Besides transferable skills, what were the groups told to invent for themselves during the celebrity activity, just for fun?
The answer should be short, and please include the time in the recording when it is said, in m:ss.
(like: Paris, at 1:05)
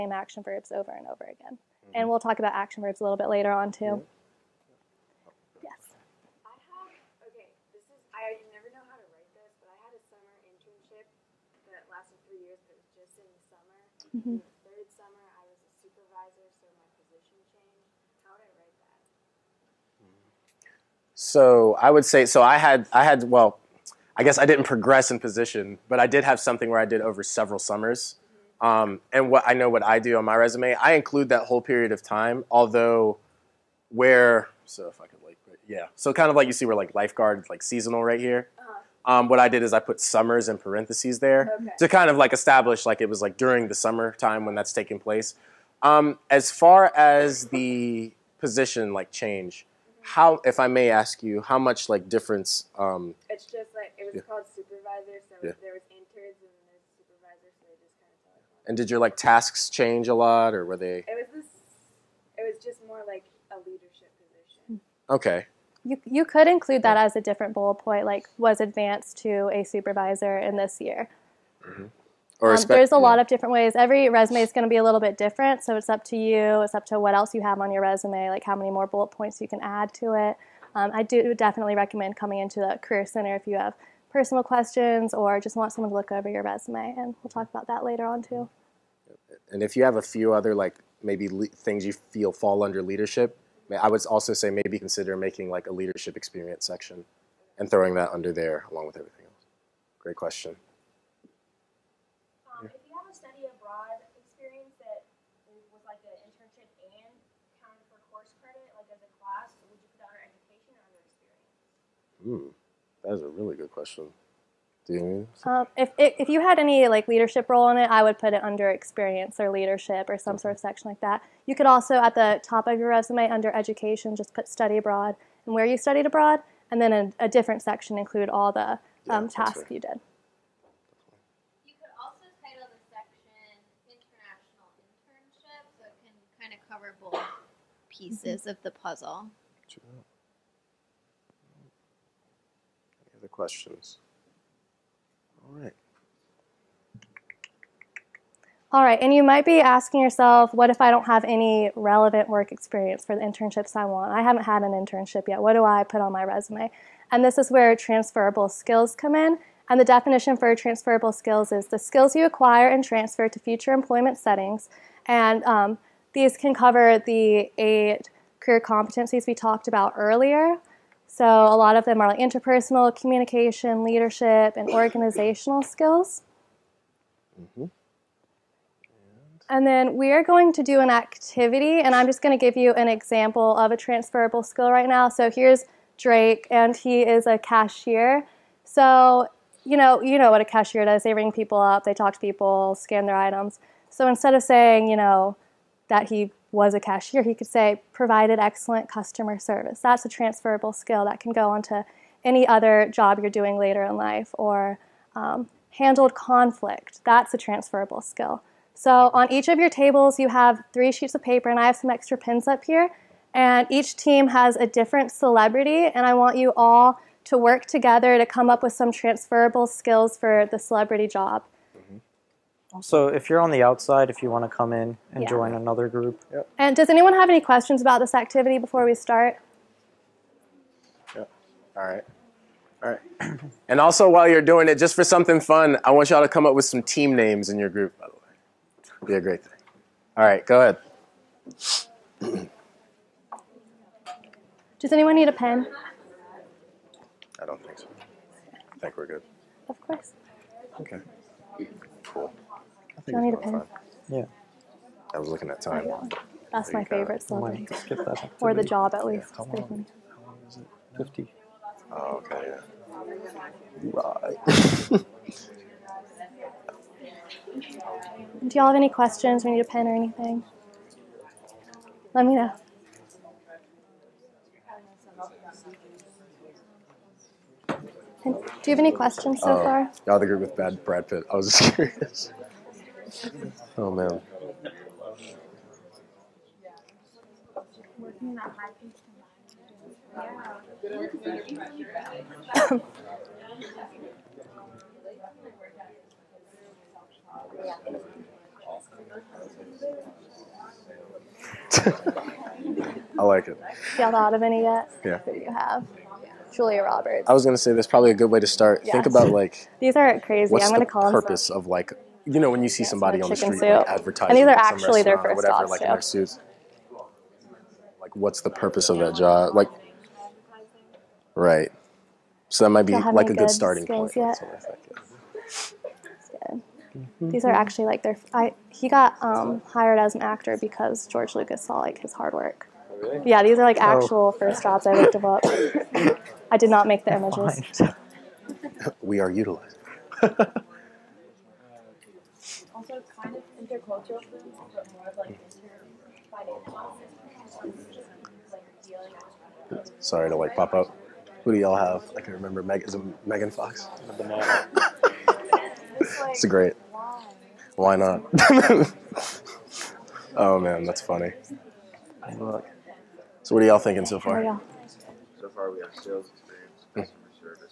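Team names, at 3:56.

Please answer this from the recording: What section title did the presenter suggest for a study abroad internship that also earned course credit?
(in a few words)
International internship.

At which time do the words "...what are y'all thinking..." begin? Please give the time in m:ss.
6:03.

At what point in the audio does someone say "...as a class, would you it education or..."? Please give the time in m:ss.
1:48.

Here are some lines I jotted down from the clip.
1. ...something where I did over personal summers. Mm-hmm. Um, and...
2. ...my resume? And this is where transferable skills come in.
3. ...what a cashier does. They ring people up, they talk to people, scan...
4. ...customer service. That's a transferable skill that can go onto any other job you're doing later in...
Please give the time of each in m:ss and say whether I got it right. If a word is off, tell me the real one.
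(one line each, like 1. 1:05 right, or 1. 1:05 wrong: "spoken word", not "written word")
1. 0:26 wrong: "several", not "personal"
2. 2:36 right
3. 3:10 right
4. 3:18 right.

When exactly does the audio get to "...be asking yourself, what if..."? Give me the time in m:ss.
2:29.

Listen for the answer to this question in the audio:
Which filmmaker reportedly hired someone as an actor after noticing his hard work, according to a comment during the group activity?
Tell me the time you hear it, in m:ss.
5:31.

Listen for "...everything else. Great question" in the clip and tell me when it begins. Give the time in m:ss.
1:38.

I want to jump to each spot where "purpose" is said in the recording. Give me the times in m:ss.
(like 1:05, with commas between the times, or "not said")
5:11, 5:18.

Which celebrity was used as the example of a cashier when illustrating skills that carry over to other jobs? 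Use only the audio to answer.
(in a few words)
Drake.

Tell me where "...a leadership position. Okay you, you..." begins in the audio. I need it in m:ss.
1:03.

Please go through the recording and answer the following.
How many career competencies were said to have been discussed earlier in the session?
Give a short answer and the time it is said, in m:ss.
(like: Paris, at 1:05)
8, at 2:47.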